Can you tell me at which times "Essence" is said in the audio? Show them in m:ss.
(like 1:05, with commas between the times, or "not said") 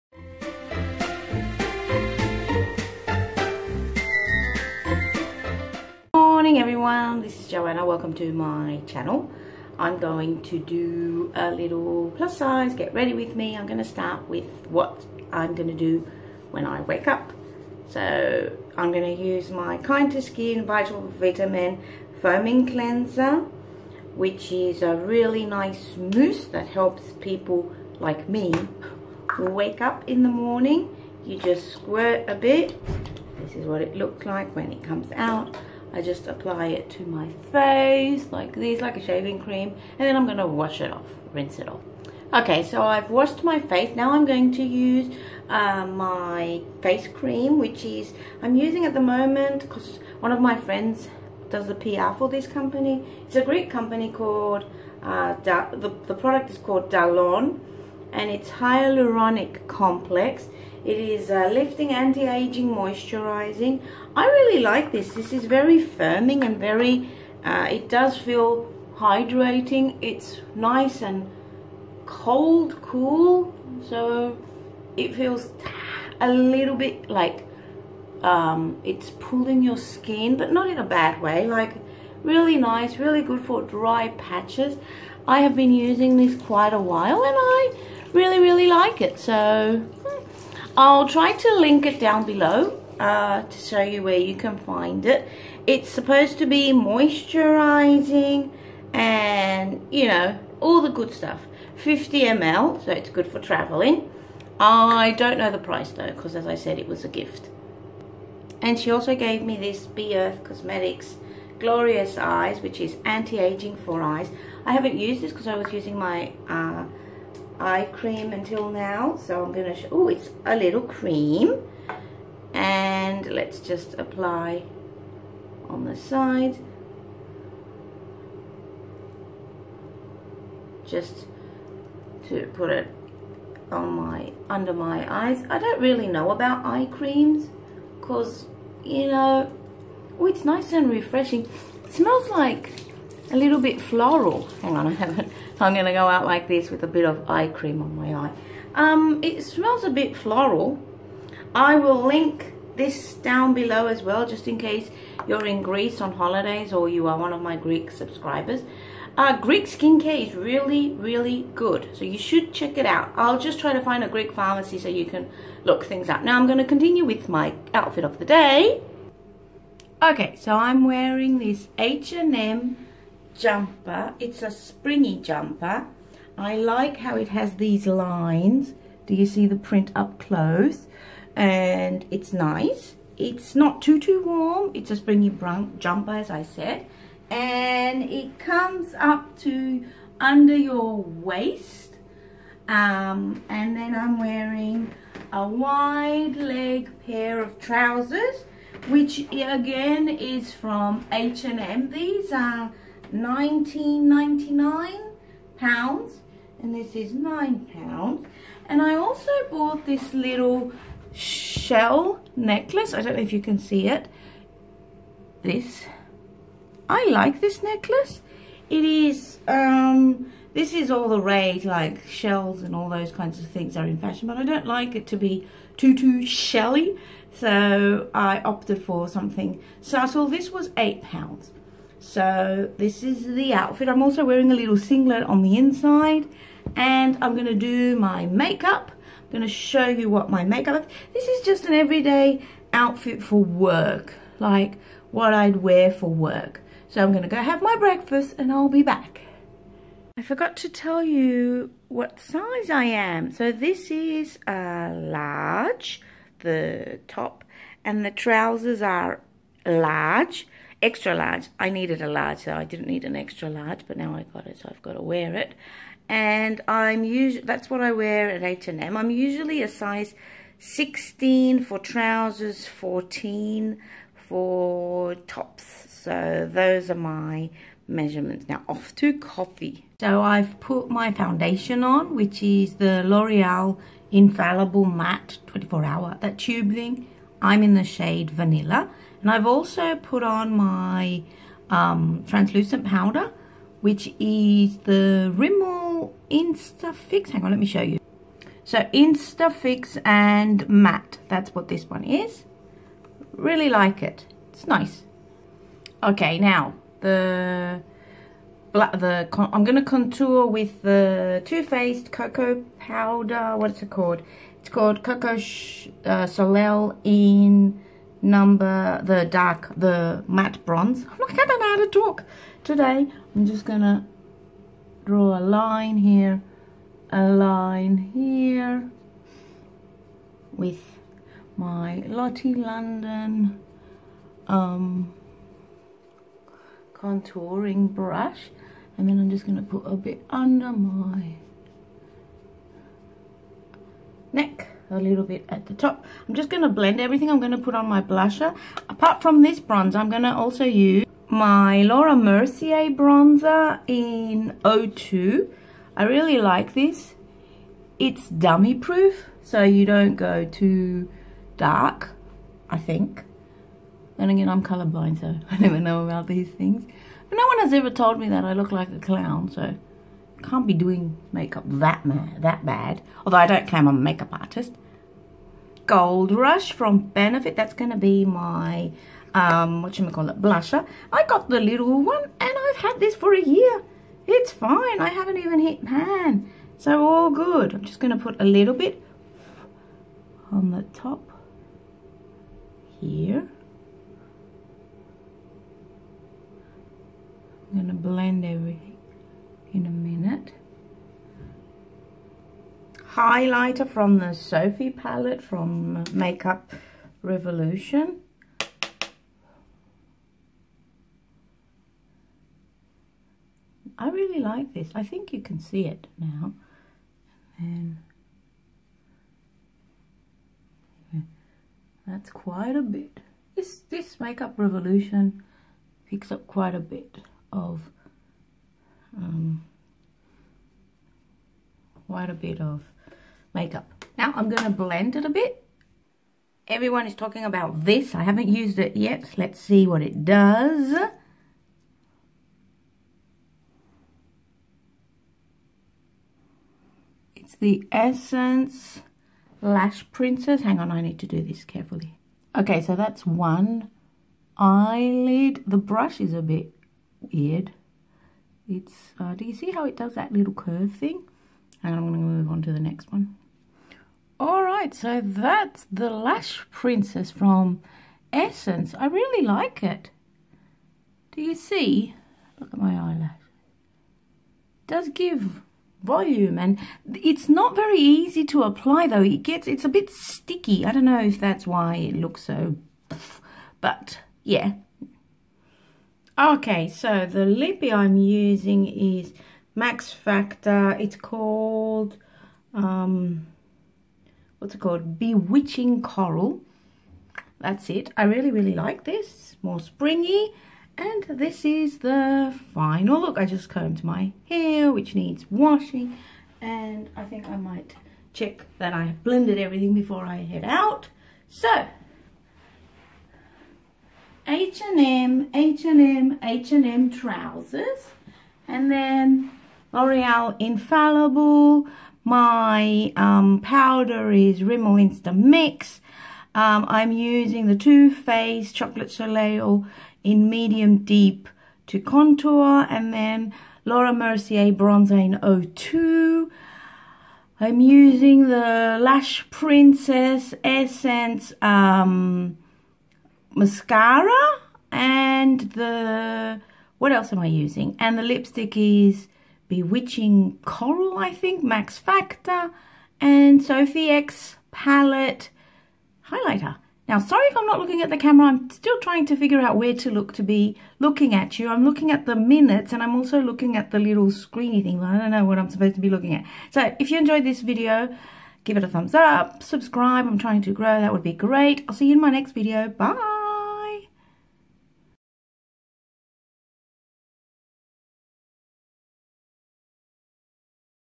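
7:27, 7:48, 9:00.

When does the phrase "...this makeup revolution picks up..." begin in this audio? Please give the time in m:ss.
7:03.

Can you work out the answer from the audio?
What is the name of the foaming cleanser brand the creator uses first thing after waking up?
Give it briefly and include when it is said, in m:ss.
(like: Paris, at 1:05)
Kind to Skin, at 0:19.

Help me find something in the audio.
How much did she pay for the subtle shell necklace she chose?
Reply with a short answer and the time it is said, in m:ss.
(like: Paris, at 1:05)
8 pounds, at 3:50.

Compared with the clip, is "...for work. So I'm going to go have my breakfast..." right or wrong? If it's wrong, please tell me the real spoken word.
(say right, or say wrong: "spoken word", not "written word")
right.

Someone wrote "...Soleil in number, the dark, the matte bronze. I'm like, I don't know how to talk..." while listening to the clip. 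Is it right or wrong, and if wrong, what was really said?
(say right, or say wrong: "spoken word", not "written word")
right.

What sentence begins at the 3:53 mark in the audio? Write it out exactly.
I'm also wearing a little singlet on the inside and I'm going to do my makeup.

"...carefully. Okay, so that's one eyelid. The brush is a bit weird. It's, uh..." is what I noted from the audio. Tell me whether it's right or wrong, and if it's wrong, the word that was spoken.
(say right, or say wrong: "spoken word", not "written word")
right.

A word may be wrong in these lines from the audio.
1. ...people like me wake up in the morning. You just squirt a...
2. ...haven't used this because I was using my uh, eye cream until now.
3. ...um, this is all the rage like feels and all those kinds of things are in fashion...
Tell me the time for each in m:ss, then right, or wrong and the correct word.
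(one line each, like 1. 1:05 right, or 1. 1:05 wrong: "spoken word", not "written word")
1. 0:27 right
2. 1:54 right
3. 3:39 wrong: "shells", not "feels".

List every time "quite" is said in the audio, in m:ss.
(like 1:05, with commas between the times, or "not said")
1:26, 7:02, 7:06, 7:12.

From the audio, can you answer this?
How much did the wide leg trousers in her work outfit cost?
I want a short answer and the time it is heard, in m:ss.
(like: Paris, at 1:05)
19.99 pounds, at 3:23.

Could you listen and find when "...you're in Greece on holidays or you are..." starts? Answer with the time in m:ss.
2:35.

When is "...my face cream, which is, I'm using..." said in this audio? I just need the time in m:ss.
0:45.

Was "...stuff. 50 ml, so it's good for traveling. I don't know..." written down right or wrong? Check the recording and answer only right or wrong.
right.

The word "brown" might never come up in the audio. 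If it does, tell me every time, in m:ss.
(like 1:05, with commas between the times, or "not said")
3:05.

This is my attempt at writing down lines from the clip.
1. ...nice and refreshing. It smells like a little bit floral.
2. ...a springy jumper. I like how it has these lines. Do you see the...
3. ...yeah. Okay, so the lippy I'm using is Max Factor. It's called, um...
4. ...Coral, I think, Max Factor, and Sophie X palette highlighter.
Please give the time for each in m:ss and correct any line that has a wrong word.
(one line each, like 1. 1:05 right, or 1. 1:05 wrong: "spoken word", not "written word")
1. 2:20 right
2. 2:54 right
3. 8:04 right
4. 9:10 right.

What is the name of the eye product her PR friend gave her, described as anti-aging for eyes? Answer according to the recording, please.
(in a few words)
Glorious Eyes.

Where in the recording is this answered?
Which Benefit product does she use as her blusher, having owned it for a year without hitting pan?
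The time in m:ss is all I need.
6:15.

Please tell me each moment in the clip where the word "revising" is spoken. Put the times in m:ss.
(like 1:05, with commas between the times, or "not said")
not said.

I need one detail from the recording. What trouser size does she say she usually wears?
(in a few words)
16.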